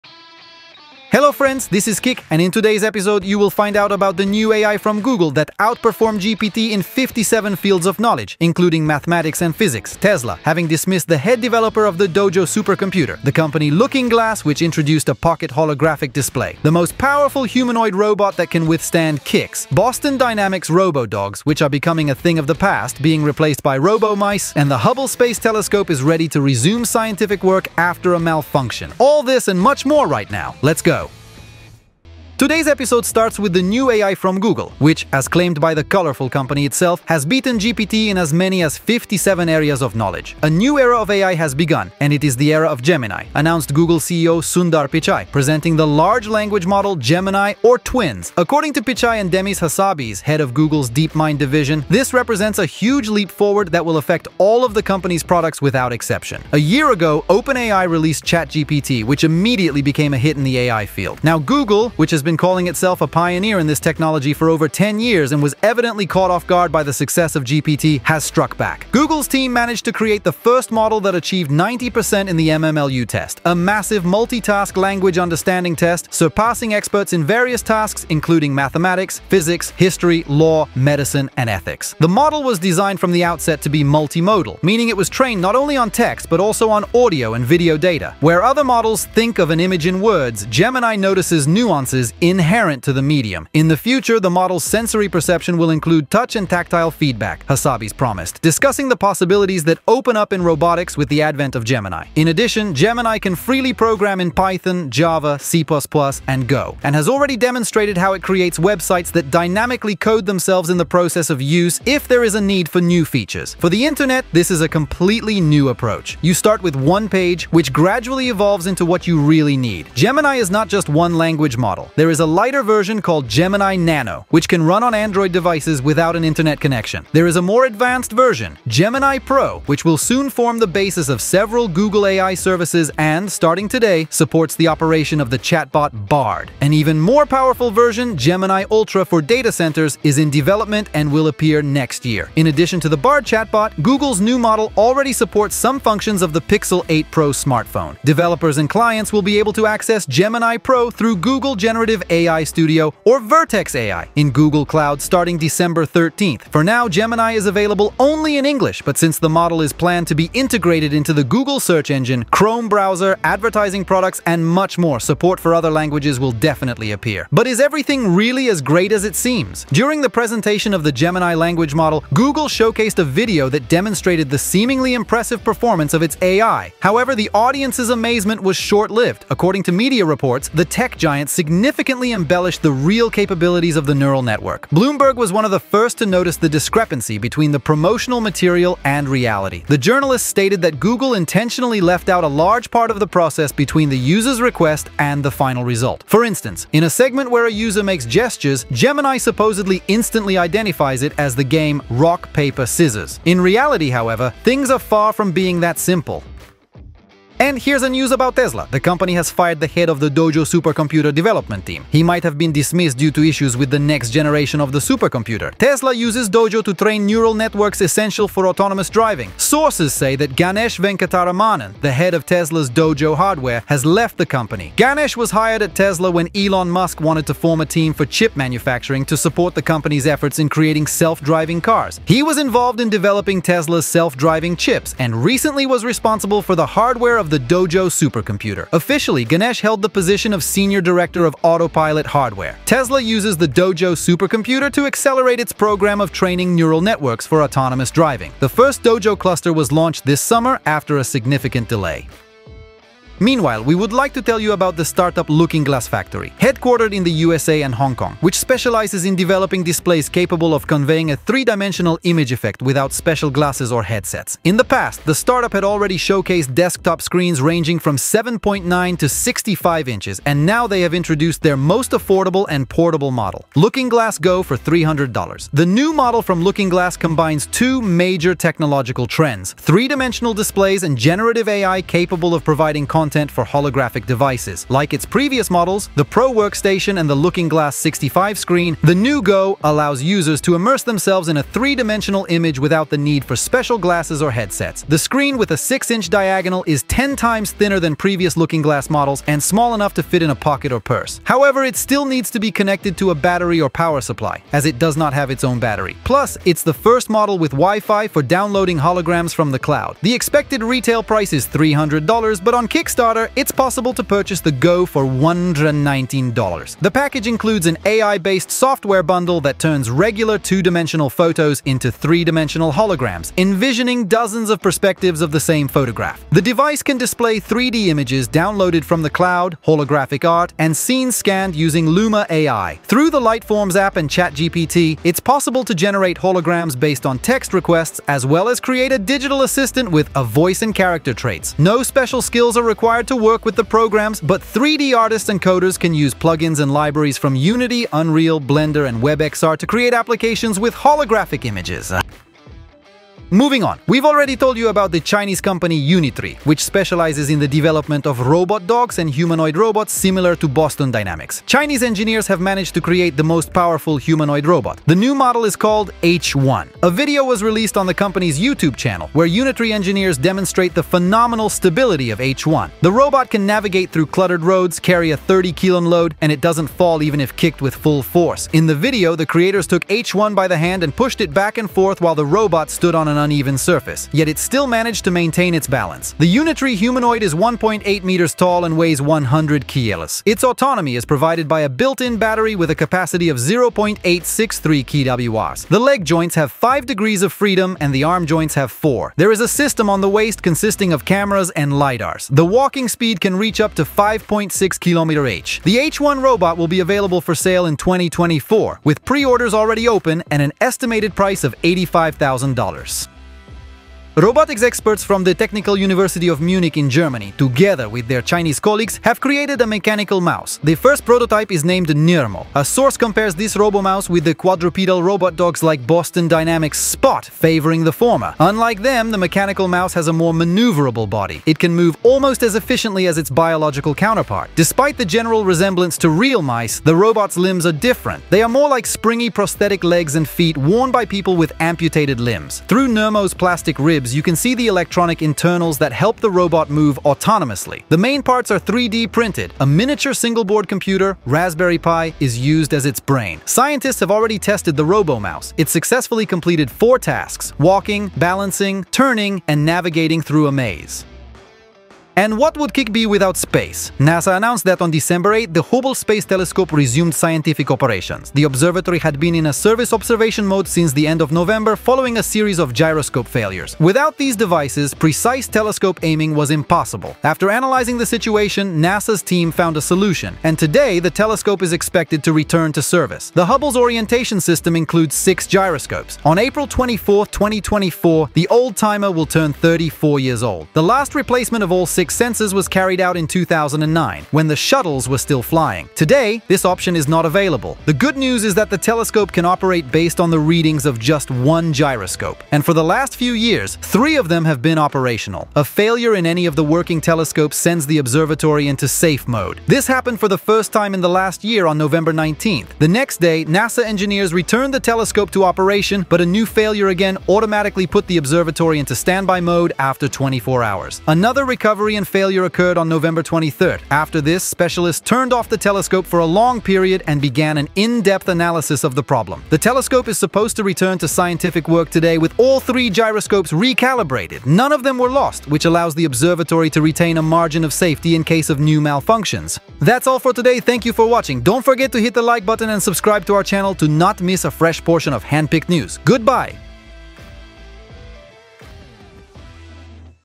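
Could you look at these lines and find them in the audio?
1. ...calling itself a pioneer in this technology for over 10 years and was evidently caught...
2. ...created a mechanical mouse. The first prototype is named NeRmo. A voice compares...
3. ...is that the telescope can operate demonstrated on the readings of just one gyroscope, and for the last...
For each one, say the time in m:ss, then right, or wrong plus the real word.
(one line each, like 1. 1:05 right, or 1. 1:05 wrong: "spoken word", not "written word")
1. 1:02 right
2. 6:59 wrong: "source", not "voice"
3. 8:18 wrong: "based", not "demonstrated".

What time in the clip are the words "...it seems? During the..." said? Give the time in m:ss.
2:49.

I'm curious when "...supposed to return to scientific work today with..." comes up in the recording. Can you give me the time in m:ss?
8:50.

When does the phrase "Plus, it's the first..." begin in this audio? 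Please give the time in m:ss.
5:06.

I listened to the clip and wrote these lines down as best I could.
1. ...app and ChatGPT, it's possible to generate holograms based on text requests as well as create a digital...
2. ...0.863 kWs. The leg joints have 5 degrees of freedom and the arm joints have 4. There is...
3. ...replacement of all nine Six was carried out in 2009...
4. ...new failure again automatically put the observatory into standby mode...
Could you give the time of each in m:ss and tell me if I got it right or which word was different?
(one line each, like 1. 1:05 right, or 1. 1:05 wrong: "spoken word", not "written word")
1. 5:33 right
2. 6:33 right
3. 8:11 wrong: "six", not "nine"
4. 8:36 right.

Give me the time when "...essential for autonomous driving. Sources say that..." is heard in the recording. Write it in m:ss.
3:37.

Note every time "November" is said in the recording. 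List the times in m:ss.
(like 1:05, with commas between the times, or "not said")
7:51, 8:31, 8:42.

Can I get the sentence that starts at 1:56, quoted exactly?
You start with one page, which gradually evolves into what you really need.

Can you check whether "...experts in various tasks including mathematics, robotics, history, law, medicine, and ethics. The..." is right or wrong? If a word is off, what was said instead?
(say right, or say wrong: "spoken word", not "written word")
wrong: "physics", not "robotics".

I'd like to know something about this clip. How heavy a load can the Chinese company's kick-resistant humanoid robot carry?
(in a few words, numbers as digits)
30 kilos.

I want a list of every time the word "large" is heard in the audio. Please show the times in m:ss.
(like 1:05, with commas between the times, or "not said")
0:45, 3:12.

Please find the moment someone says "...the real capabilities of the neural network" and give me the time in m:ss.
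3:02.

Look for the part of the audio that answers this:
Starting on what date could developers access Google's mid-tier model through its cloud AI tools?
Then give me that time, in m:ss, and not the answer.
2:35.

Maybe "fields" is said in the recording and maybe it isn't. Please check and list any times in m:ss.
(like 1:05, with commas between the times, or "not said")
0:07, 1:00.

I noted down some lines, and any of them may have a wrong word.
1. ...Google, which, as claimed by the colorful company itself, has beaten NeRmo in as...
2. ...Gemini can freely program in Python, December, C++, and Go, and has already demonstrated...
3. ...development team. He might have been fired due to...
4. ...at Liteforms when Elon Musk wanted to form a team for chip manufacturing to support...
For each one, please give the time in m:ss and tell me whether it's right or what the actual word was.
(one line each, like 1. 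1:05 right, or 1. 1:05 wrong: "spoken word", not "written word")
1. 0:34 wrong: "GPT", not "NeRmo"
2. 1:42 wrong: "Java", not "December"
3. 3:31 wrong: "dismissed", not "fired"
4. 3:45 wrong: "Tesla", not "Liteforms".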